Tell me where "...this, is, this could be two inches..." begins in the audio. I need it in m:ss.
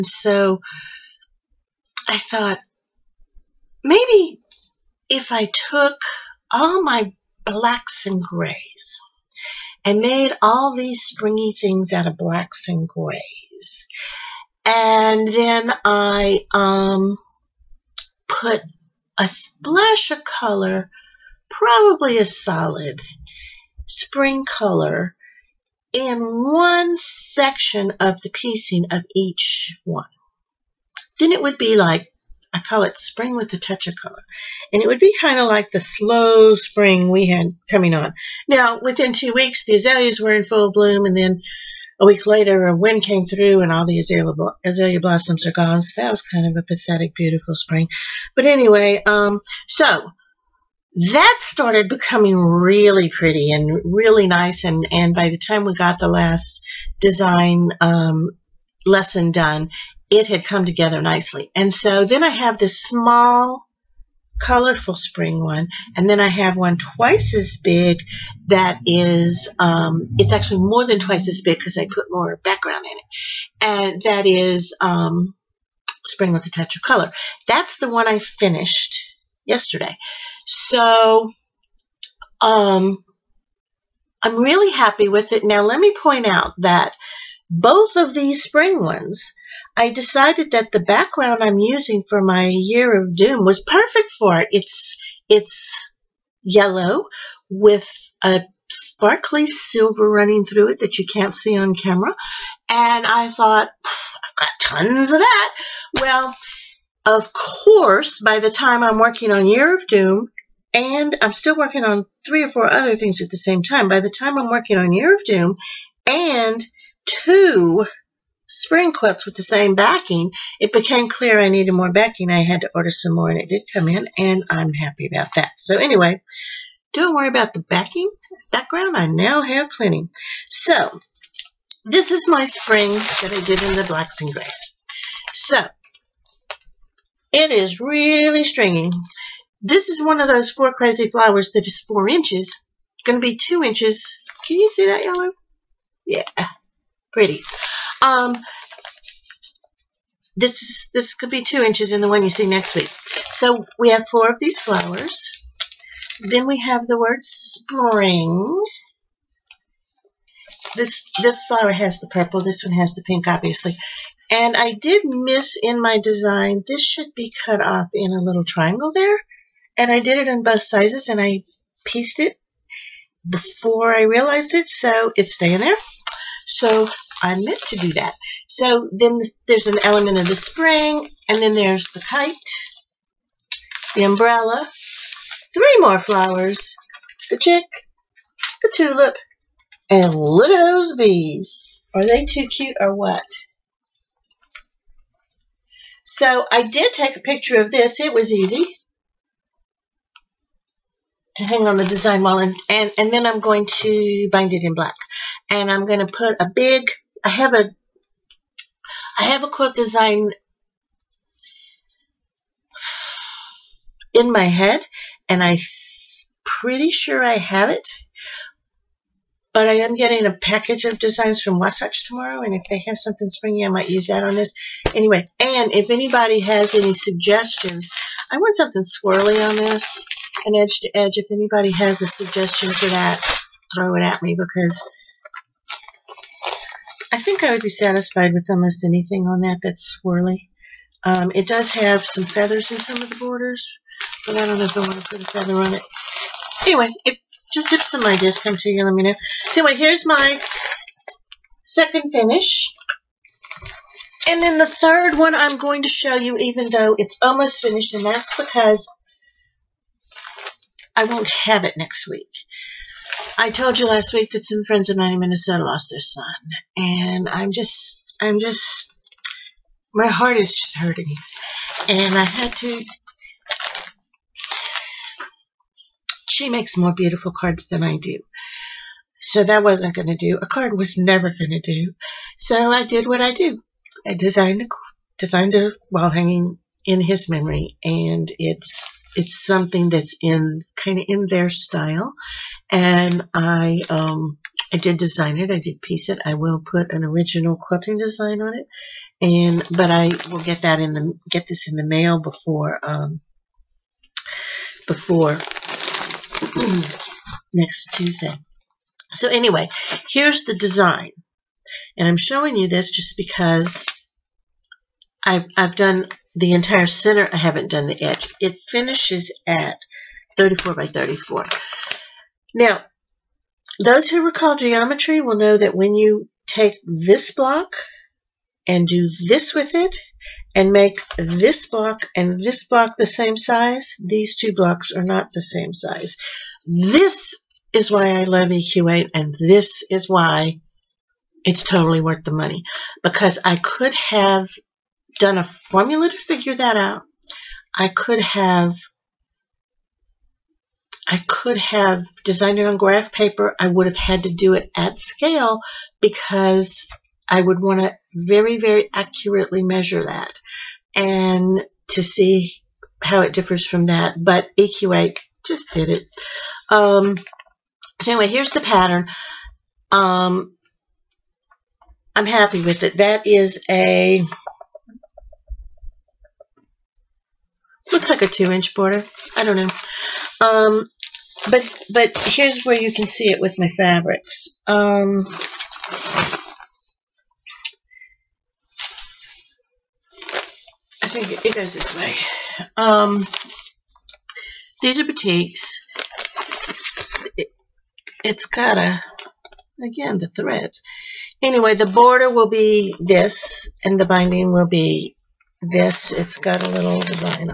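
2:30.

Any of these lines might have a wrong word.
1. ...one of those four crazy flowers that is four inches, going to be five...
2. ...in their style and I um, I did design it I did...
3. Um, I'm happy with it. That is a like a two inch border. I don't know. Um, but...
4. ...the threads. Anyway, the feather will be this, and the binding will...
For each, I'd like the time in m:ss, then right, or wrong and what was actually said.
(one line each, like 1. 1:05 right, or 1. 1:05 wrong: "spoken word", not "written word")
1. 2:20 wrong: "two", not "five"
2. 4:51 right
3. 6:09 right
4. 6:40 wrong: "border", not "feather".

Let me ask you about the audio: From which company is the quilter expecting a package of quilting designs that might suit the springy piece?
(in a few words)
Wasatch.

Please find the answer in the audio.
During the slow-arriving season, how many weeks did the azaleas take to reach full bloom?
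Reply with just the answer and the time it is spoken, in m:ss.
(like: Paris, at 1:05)
2, at 0:39.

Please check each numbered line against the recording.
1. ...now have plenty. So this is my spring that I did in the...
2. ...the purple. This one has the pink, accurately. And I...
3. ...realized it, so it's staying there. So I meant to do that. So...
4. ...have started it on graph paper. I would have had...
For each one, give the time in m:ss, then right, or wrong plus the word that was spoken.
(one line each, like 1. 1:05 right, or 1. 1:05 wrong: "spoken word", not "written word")
1. 2:09 right
2. 2:41 wrong: "obviously", not "accurately"
3. 2:54 right
4. 5:51 wrong: "designed", not "started".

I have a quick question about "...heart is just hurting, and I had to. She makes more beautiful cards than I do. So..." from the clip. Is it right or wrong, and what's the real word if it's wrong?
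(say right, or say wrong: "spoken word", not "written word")
right.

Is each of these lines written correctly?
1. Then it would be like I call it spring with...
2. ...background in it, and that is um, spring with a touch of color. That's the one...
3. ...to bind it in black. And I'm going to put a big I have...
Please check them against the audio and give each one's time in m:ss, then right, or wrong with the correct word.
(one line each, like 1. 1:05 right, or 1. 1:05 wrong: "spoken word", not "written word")
1. 0:31 right
2. 1:12 right
3. 3:23 right.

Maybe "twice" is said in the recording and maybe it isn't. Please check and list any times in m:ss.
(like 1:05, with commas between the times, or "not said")
1:06, 1:10.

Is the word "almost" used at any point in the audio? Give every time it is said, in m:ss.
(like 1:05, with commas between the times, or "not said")
3:58, 4:17.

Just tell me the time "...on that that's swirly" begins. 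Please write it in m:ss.
3:59.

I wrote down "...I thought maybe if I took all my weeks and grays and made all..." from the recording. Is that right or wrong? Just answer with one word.
wrong.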